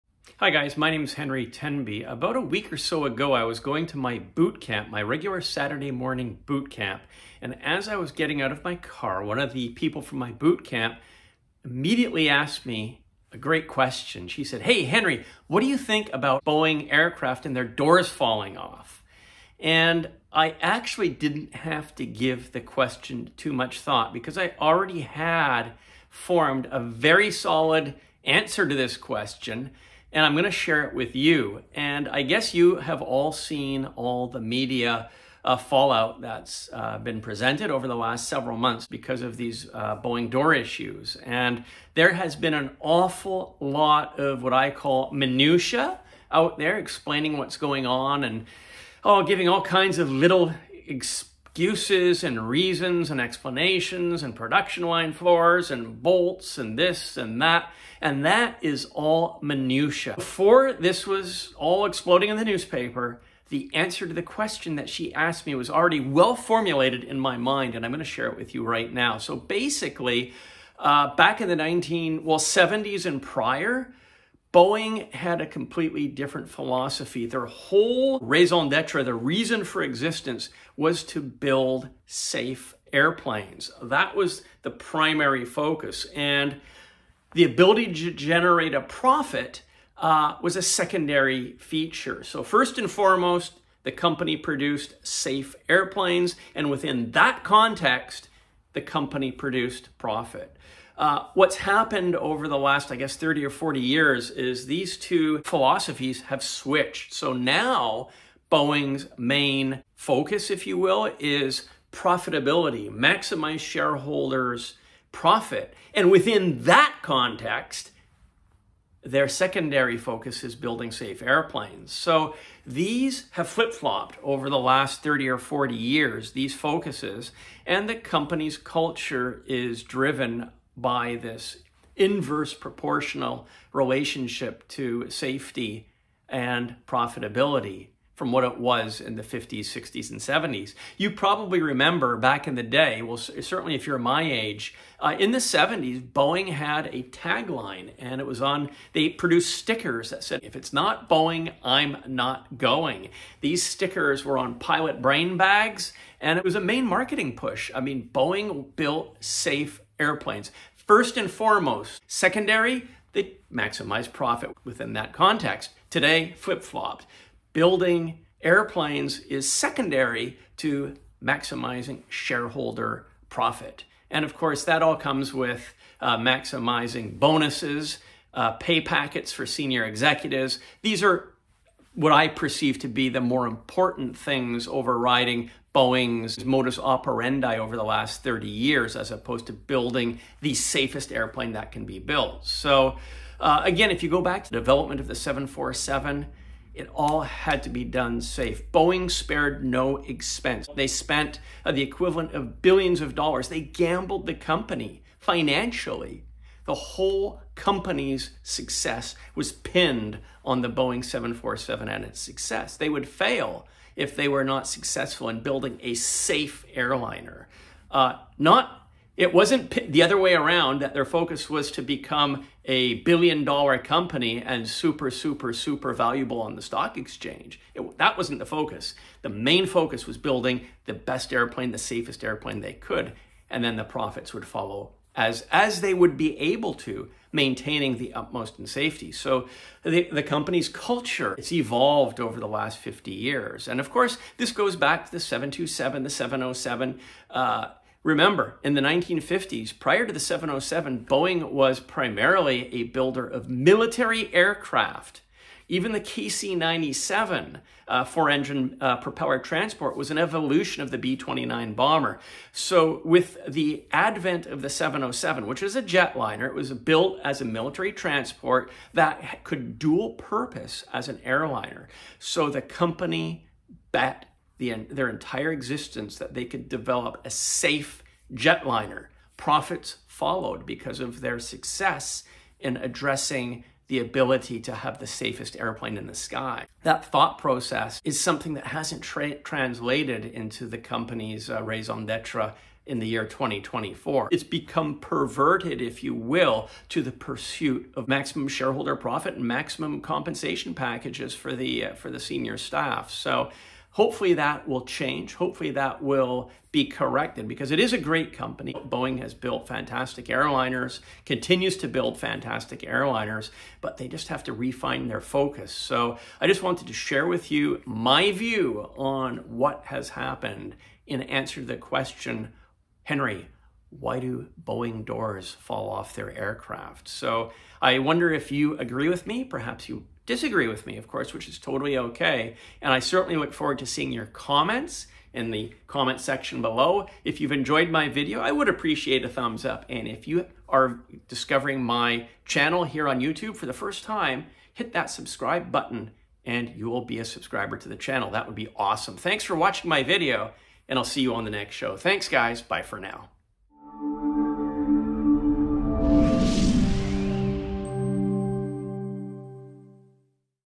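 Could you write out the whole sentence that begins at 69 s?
So basically, uh, back in the 19, well, 70s and prior, Boeing had a completely different philosophy.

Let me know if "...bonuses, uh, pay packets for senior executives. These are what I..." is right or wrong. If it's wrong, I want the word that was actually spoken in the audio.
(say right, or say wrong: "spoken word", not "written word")
right.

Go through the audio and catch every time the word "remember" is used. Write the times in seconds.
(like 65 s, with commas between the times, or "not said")
141 s, 248 s.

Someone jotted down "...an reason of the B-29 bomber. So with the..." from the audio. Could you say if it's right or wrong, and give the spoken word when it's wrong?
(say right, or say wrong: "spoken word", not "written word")
wrong: "evolution", not "reason".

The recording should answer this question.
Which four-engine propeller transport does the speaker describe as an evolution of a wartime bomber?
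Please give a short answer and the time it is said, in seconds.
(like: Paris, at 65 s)
KC-97, at 256 s.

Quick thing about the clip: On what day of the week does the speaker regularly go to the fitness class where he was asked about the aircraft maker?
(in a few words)
Saturday.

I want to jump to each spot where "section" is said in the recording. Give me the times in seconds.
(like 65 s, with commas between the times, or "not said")
336 s.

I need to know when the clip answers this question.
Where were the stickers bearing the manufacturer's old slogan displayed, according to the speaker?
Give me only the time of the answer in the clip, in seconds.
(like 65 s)
154 s.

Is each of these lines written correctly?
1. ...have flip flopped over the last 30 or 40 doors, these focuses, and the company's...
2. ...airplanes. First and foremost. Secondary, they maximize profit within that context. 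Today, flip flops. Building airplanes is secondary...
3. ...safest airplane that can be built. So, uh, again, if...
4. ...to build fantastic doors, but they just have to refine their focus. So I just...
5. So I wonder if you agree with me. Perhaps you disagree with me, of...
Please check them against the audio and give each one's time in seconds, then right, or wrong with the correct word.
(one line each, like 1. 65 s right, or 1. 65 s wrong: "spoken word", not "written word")
1. 123 s wrong: "years", not "doors"
2. 159 s right
3. 190 s right
4. 311 s wrong: "airliners", not "doors"
5. 327 s right.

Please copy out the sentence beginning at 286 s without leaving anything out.
That thought process is something that hasn't tra translated into the company's uh, raison d'etre in the year 2024.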